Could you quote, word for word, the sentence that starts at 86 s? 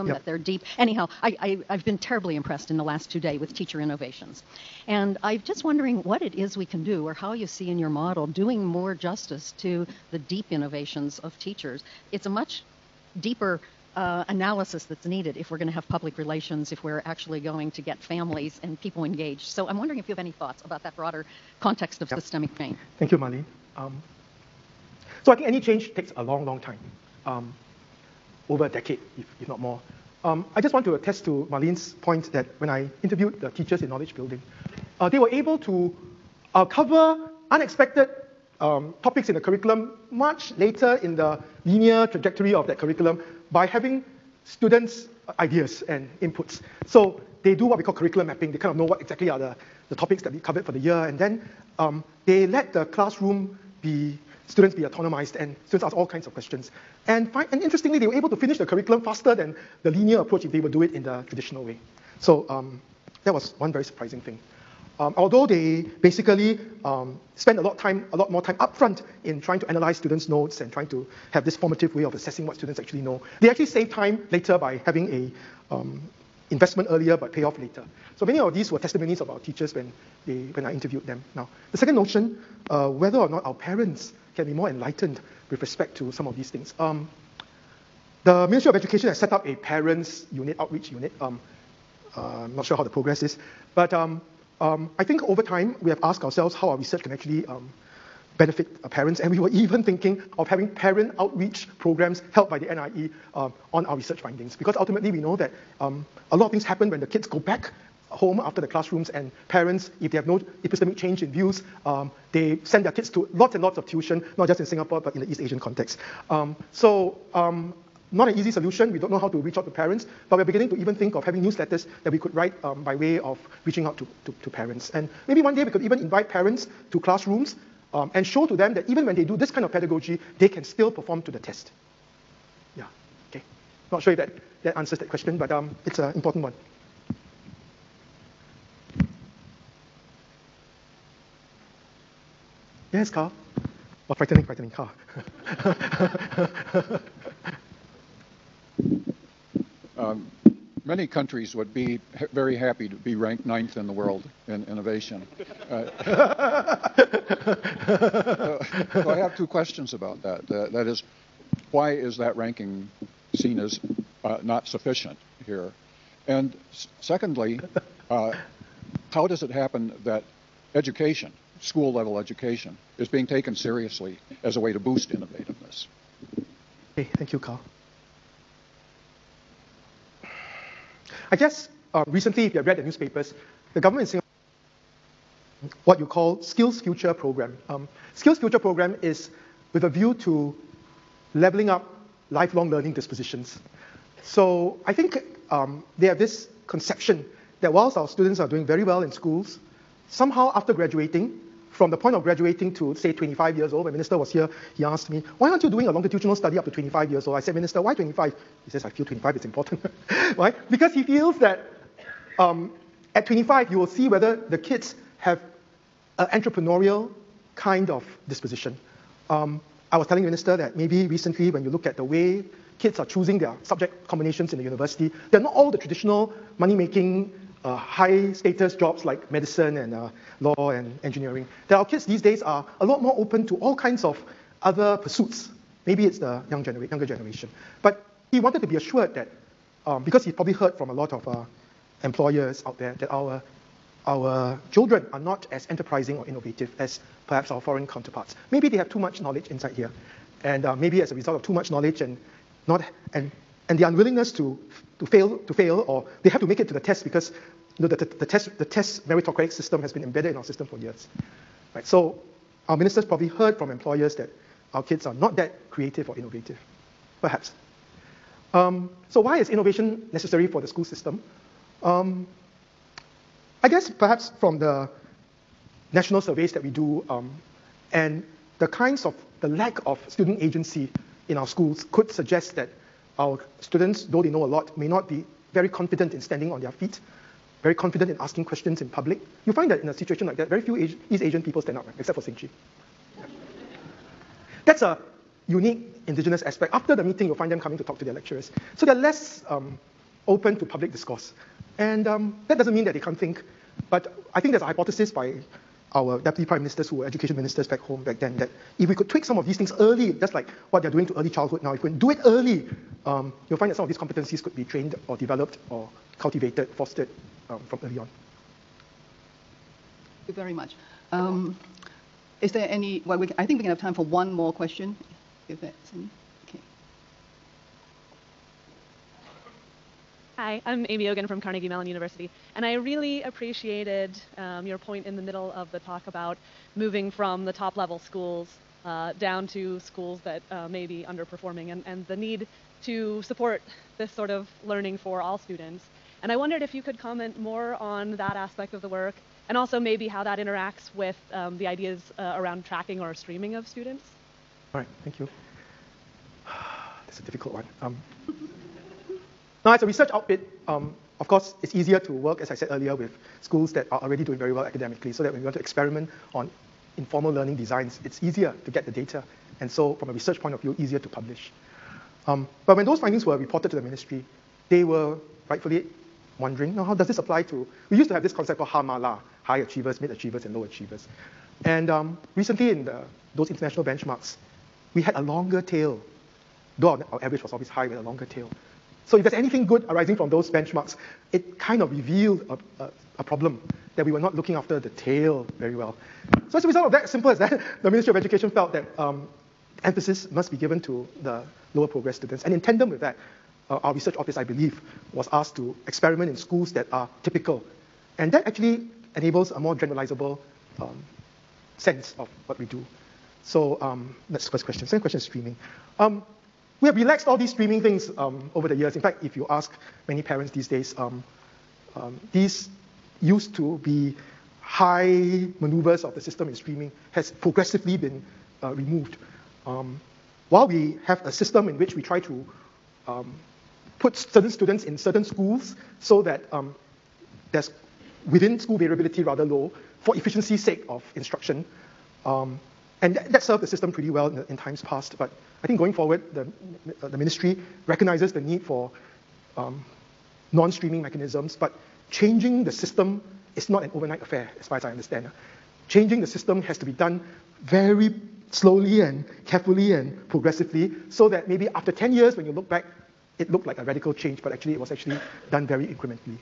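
Um, the Ministry of Education has set up a parents unit, outreach unit.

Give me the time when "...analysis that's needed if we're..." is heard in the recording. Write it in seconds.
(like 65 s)
14 s.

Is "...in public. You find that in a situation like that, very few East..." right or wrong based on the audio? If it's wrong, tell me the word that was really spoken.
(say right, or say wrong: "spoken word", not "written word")
right.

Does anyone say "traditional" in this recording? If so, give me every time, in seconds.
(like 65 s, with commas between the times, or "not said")
61 s, 225 s.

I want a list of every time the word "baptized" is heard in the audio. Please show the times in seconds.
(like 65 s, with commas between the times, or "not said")
not said.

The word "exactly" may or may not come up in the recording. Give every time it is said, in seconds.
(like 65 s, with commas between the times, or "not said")
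48 s.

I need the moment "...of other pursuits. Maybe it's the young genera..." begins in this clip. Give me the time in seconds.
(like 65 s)
234 s.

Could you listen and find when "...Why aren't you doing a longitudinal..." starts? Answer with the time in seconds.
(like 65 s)
205 s.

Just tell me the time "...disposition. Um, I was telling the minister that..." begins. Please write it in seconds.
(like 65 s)
218 s.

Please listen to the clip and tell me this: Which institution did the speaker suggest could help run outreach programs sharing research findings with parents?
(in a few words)
NIE.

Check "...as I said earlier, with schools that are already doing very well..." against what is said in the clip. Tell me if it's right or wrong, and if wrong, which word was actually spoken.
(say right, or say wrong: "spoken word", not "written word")
right.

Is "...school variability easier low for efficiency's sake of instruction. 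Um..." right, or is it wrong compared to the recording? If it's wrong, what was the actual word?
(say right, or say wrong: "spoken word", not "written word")
wrong: "rather", not "easier".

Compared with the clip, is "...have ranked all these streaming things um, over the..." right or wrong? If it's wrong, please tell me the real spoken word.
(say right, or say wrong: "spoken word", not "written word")
wrong: "relaxed", not "ranked".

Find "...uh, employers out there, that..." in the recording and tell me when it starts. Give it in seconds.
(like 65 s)
241 s.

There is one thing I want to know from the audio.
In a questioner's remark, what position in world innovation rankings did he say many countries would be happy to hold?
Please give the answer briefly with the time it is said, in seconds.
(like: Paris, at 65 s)
Ninth, at 153 s.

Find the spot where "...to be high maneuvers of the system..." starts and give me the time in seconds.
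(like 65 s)
423 s.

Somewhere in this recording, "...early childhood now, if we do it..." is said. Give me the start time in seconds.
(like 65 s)
311 s.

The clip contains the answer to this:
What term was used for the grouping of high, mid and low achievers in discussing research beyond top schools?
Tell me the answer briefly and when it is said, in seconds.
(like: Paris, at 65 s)
Hamala, at 378 s.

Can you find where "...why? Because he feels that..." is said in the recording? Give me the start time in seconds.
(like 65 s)
210 s.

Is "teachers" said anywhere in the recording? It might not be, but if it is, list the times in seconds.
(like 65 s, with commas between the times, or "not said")
3 s, 11 s, 33 s, 79 s.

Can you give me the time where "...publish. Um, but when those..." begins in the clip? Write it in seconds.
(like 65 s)
371 s.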